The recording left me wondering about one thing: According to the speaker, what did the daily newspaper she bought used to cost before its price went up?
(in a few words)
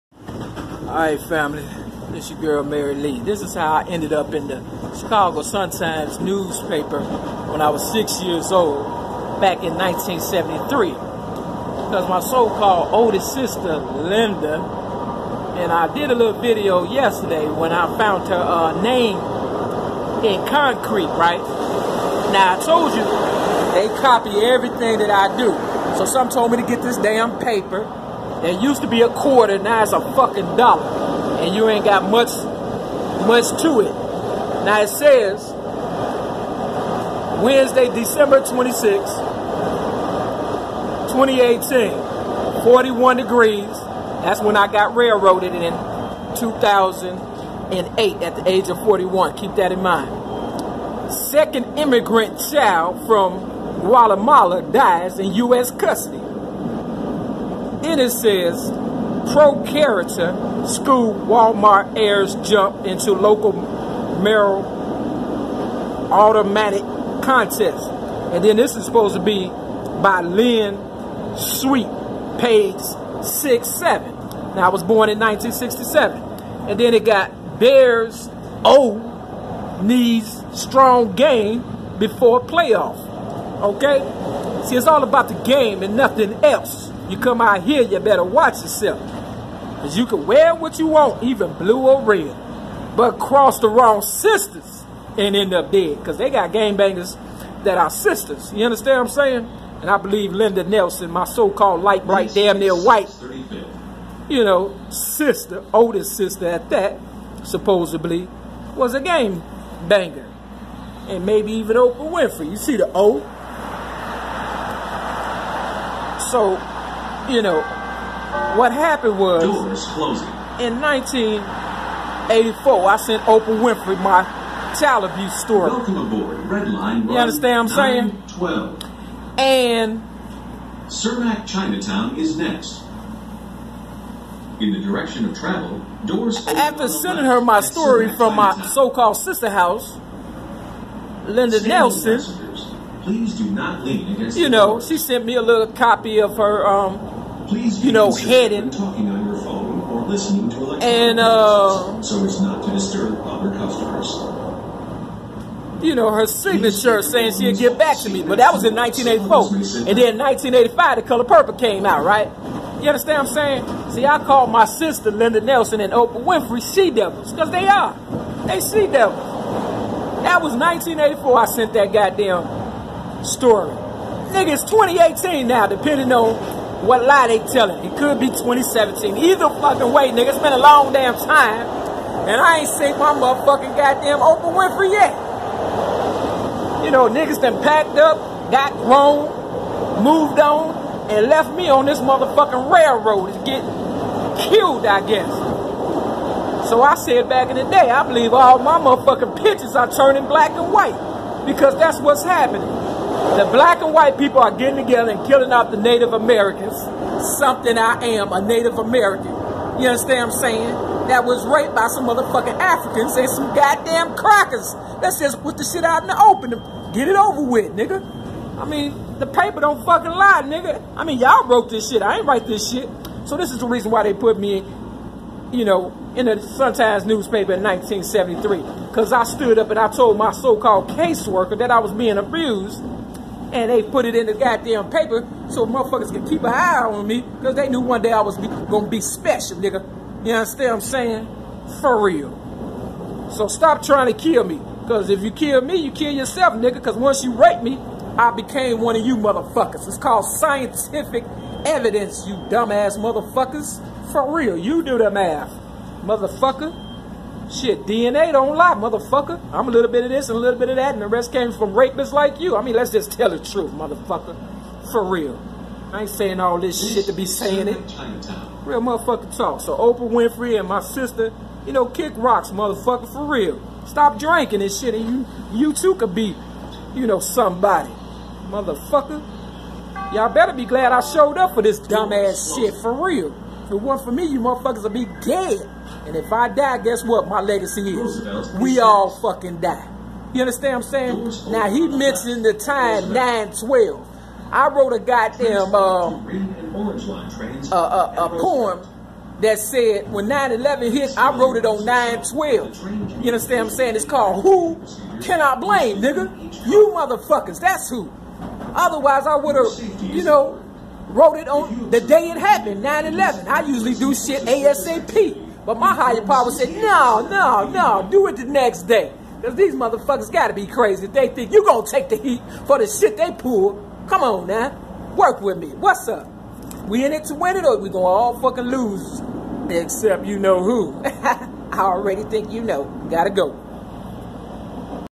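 a quarter.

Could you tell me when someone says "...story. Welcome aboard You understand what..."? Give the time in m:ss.
2:05.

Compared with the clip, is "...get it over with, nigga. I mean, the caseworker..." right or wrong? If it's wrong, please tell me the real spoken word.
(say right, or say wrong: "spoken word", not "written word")
wrong: "paper", not "caseworker".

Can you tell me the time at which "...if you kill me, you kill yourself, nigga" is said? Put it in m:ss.
4:05.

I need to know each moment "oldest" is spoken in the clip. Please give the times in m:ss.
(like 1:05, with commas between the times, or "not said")
0:12, 1:45.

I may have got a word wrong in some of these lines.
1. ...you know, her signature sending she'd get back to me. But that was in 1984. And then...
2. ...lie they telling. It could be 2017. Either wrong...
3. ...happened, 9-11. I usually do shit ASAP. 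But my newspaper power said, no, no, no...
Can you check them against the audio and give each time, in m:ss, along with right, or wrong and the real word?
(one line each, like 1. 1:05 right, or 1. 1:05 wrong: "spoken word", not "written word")
1. 2:35 wrong: "saying", not "sending"
2. 2:57 wrong: "fucking", not "wrong"
3. 5:12 wrong: "higher", not "newspaper".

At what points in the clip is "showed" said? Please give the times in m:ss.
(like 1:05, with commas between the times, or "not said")
4:41.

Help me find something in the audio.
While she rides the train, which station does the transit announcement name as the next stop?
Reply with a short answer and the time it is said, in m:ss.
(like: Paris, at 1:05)
Cermak Chinatown, at 2:10.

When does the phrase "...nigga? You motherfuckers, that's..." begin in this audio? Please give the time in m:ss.
5:05.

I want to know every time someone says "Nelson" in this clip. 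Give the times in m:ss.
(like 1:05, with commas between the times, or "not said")
1:40, 2:21, 2:45.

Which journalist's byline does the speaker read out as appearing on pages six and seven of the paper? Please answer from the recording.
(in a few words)
Lynn Sweet.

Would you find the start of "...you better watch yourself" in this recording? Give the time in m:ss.
1:27.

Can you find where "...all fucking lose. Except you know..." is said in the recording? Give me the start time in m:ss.
5:28.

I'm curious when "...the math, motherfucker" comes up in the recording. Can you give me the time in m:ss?
4:14.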